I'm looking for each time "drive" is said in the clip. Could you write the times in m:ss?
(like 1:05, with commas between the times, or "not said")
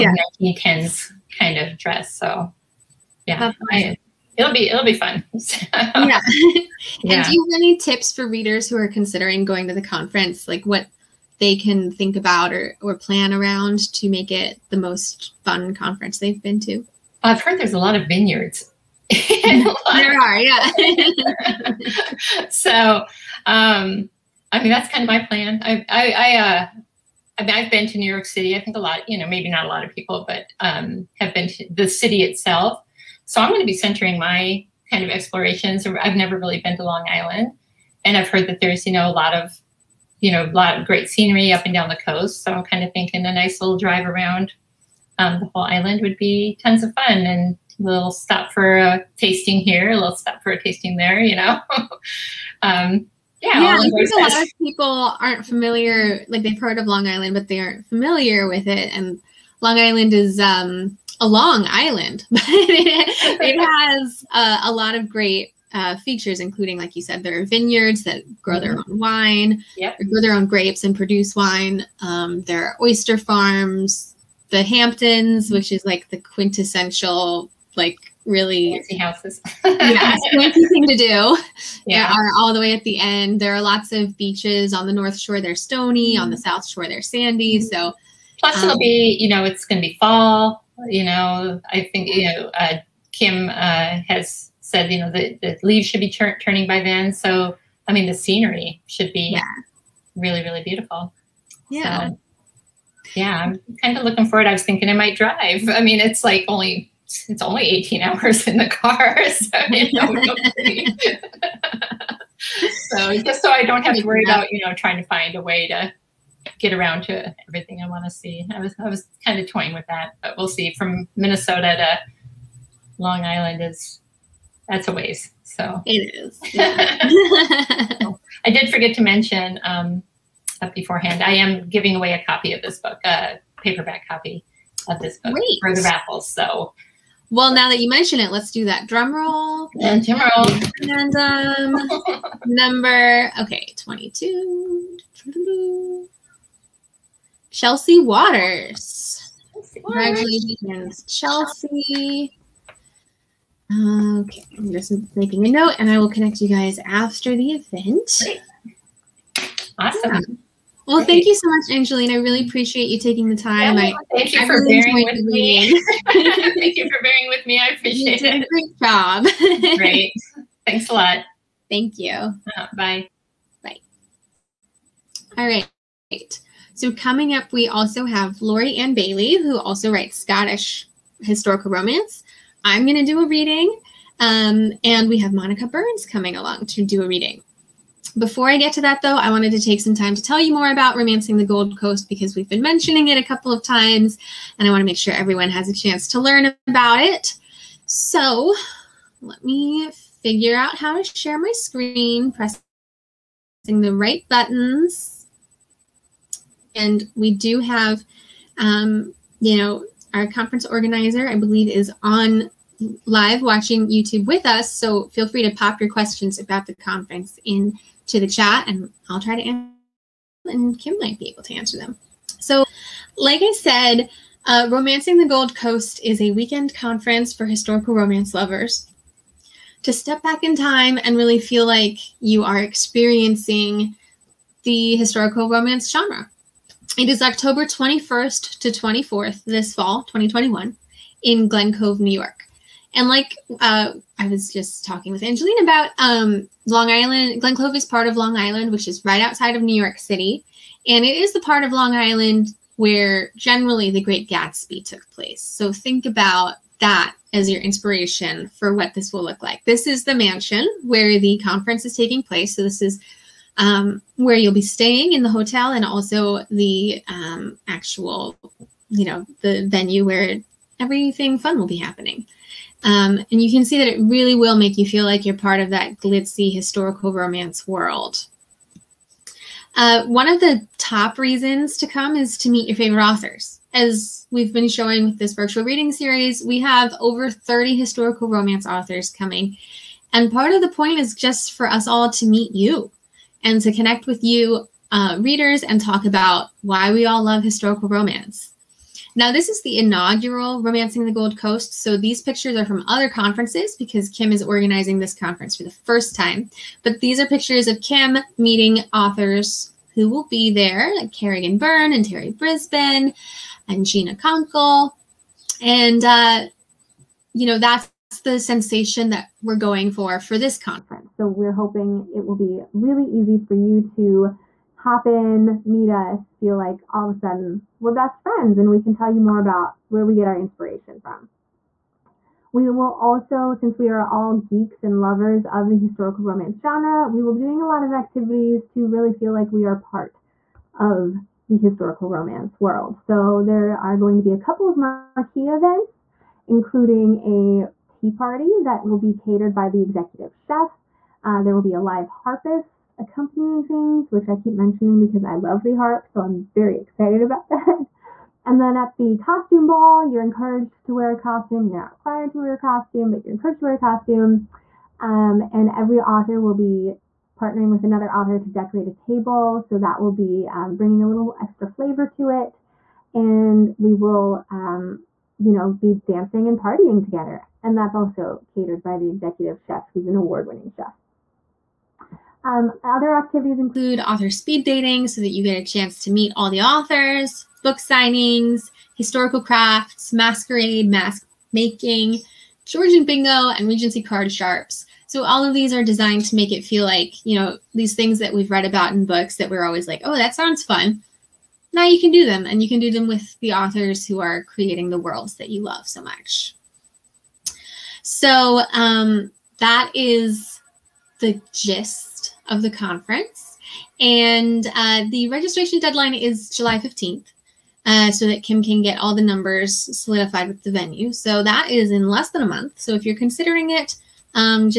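0:43, 1:45.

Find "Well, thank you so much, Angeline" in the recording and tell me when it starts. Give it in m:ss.
2:40.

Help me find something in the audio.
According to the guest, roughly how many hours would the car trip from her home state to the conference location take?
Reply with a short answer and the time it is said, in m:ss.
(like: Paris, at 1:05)
18, at 1:47.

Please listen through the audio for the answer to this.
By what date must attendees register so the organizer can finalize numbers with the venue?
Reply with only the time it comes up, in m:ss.
6:56.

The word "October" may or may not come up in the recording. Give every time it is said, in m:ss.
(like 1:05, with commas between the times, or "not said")
3:57.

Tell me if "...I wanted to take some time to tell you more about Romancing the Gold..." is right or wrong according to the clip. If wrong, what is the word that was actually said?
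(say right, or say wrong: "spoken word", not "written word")
right.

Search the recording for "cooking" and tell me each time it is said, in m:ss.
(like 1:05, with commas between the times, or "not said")
not said.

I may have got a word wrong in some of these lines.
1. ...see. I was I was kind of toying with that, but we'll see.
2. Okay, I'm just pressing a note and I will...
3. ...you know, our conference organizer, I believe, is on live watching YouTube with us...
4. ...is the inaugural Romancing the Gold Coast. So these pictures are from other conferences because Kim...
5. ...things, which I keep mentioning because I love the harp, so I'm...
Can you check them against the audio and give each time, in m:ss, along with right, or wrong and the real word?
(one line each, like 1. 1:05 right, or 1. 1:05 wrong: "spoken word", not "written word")
1. 1:58 right
2. 2:33 wrong: "making", not "pressing"
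3. 3:29 right
4. 4:59 right
5. 5:53 right.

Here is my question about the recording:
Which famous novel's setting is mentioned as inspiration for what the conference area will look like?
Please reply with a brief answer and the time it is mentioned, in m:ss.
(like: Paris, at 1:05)
The Great Gatsby, at 4:13.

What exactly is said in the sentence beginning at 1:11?
Um, there are oyster farms, the Hamptons, which is like the quintessential, like really fancy houses.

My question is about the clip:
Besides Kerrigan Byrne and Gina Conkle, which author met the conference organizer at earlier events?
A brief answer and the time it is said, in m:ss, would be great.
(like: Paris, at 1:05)
Terri Brisbin, at 5:12.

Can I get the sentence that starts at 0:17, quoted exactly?
I've heard there's a lot of vineyards.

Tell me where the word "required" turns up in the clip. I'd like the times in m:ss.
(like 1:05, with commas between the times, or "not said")
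6:01.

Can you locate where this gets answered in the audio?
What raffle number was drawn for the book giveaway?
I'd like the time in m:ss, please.
2:23.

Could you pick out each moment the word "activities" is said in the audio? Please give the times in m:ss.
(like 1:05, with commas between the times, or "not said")
5:37, 6:23.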